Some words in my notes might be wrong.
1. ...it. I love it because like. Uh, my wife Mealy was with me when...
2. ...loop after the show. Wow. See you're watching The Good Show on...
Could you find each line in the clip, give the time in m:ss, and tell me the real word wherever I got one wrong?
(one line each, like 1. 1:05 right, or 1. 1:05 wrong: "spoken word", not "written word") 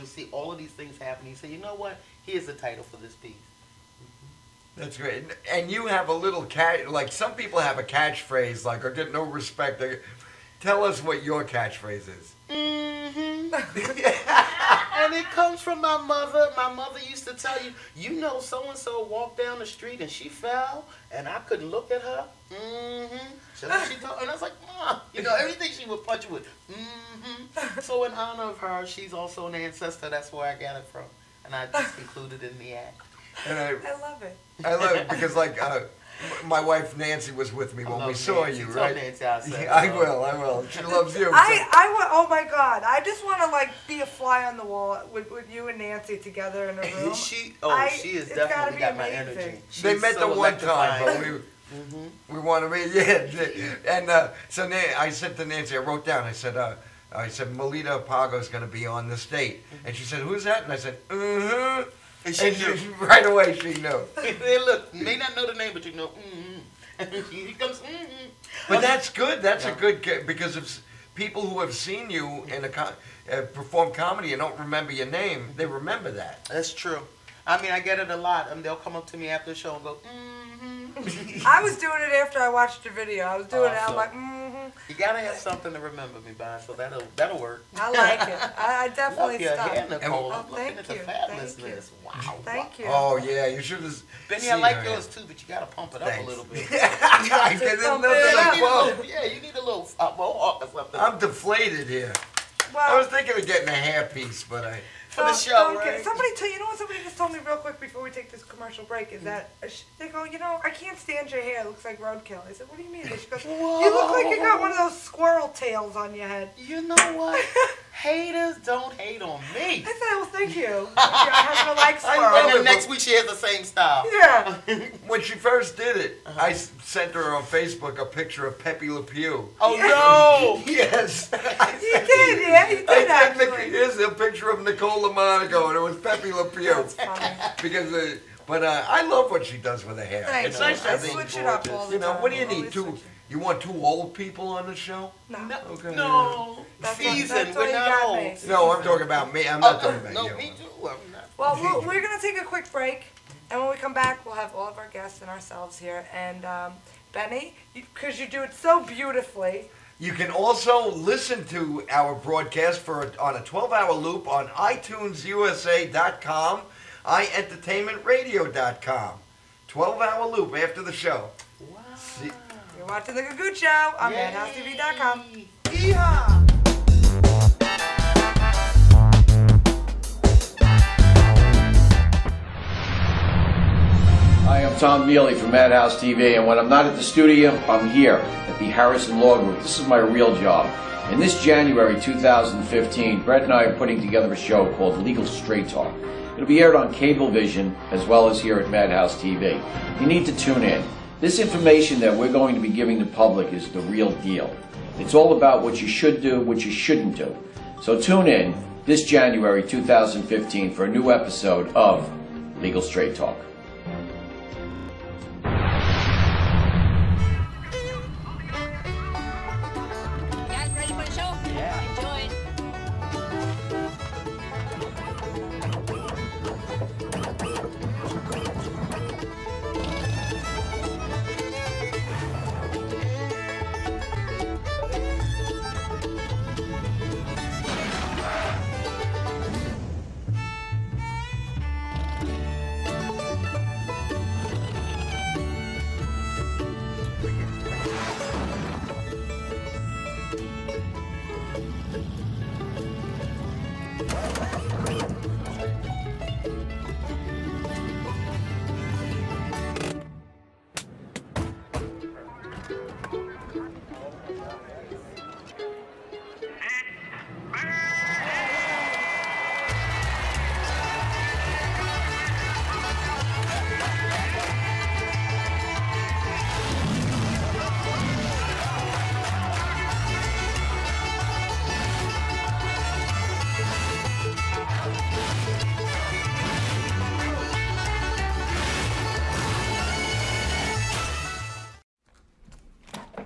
1. 0:34 wrong: "Nancy", not "Mealy"
2. 2:50 right.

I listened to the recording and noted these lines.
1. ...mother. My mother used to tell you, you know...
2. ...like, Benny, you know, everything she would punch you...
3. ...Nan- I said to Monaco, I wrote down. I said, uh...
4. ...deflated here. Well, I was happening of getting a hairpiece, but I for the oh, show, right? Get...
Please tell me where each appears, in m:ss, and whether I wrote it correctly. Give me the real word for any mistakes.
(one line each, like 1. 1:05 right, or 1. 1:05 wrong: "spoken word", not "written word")
1. 0:16 right
2. 0:24 wrong: "Mom", not "Benny"
3. 0:54 wrong: "Nancy", not "Monaco"
4. 1:41 wrong: "thinking", not "happening".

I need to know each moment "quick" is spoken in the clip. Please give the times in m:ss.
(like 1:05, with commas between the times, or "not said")
1:47, 2:32.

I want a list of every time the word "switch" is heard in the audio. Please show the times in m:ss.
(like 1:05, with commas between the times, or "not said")
2:21.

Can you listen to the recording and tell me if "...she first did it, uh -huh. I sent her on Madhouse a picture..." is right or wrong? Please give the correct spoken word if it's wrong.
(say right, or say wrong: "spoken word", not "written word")
wrong: "Facebook", not "Madhouse".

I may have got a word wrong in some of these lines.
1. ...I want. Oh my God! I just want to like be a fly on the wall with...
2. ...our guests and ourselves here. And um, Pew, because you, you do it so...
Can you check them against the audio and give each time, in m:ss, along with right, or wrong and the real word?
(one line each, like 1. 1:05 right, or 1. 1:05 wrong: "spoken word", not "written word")
1. 0:41 right
2. 2:34 wrong: "Benny", not "Pew".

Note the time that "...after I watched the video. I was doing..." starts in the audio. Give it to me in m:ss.
1:22.